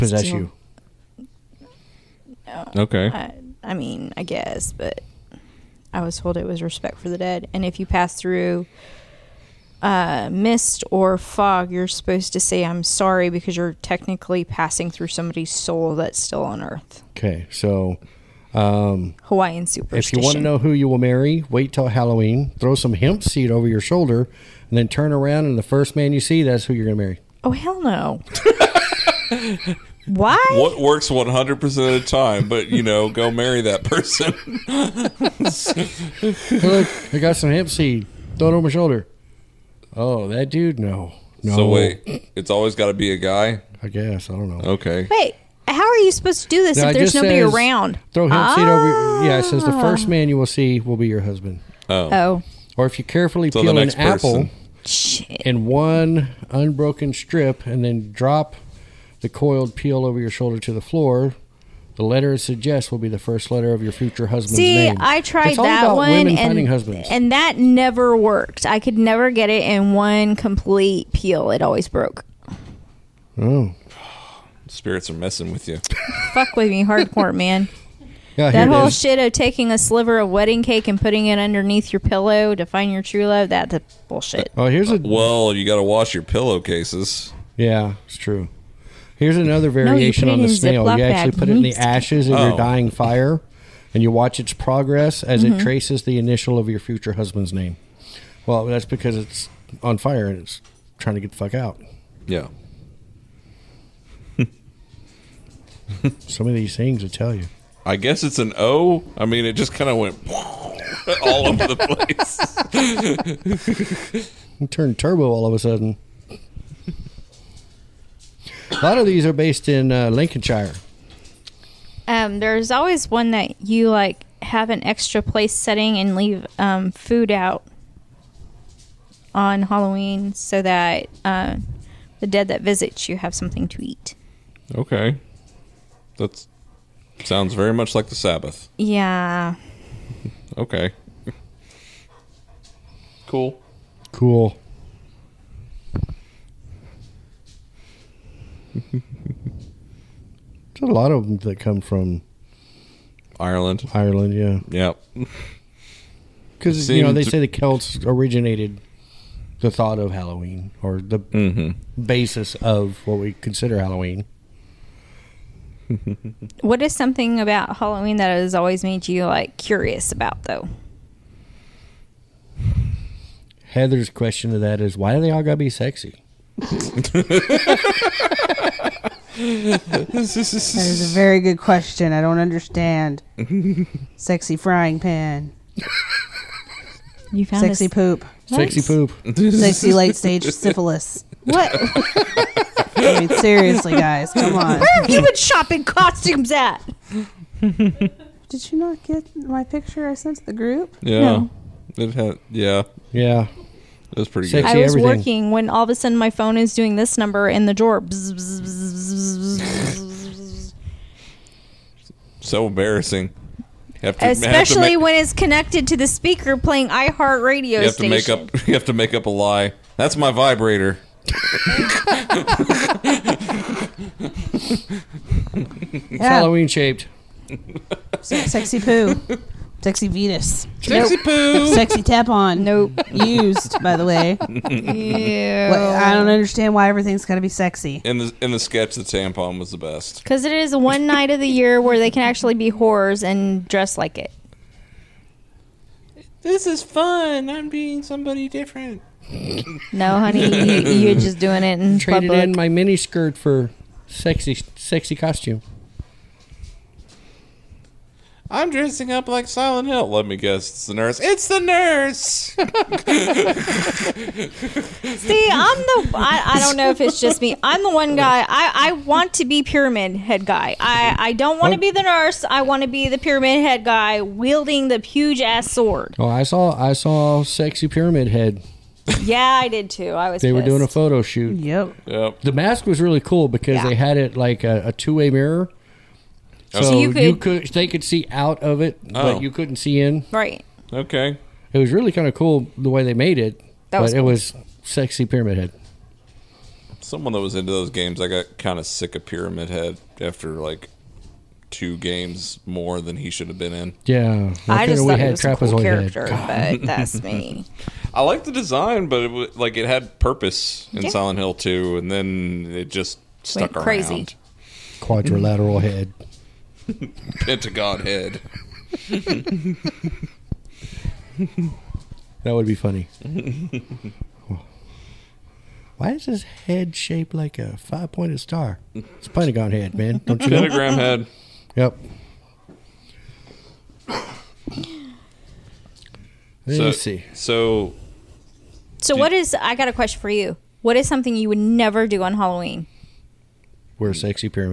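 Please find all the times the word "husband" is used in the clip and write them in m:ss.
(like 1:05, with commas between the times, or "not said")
0:51, 1:04, 1:37.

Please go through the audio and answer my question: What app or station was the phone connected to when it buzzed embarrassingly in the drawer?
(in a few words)
iHeartRadio.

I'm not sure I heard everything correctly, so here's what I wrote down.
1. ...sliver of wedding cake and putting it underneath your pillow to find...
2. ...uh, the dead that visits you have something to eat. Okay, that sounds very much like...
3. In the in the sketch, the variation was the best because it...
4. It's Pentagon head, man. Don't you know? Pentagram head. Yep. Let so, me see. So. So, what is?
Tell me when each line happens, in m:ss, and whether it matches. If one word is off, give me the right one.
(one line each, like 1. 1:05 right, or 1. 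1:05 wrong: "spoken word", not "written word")
1. 1:19 right
2. 2:11 right
3. 3:58 wrong: "tampon", not "variation"
4. 5:28 right.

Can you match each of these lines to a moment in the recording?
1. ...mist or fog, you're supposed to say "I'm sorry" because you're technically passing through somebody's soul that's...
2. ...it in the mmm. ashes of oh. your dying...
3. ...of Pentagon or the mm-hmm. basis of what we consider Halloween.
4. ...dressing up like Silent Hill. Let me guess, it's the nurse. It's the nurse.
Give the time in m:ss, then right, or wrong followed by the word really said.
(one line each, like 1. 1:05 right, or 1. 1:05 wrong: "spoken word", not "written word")
1. 0:10 right
2. 1:31 right
3. 2:39 wrong: "Halloween", not "Pentagon"
4. 4:18 right.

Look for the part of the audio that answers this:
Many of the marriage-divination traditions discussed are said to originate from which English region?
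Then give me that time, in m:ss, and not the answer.
2:00.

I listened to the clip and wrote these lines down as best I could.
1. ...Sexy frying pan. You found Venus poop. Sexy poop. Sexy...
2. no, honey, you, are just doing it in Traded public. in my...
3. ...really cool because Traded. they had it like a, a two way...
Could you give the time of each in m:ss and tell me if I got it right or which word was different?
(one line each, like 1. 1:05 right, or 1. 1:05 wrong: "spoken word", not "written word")
1. 3:04 wrong: "Sexy", not "Venus"
2. 4:09 right
3. 4:43 wrong: "Yeah", not "Traded".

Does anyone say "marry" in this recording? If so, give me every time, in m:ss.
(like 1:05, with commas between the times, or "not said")
0:20, 0:27, 0:33.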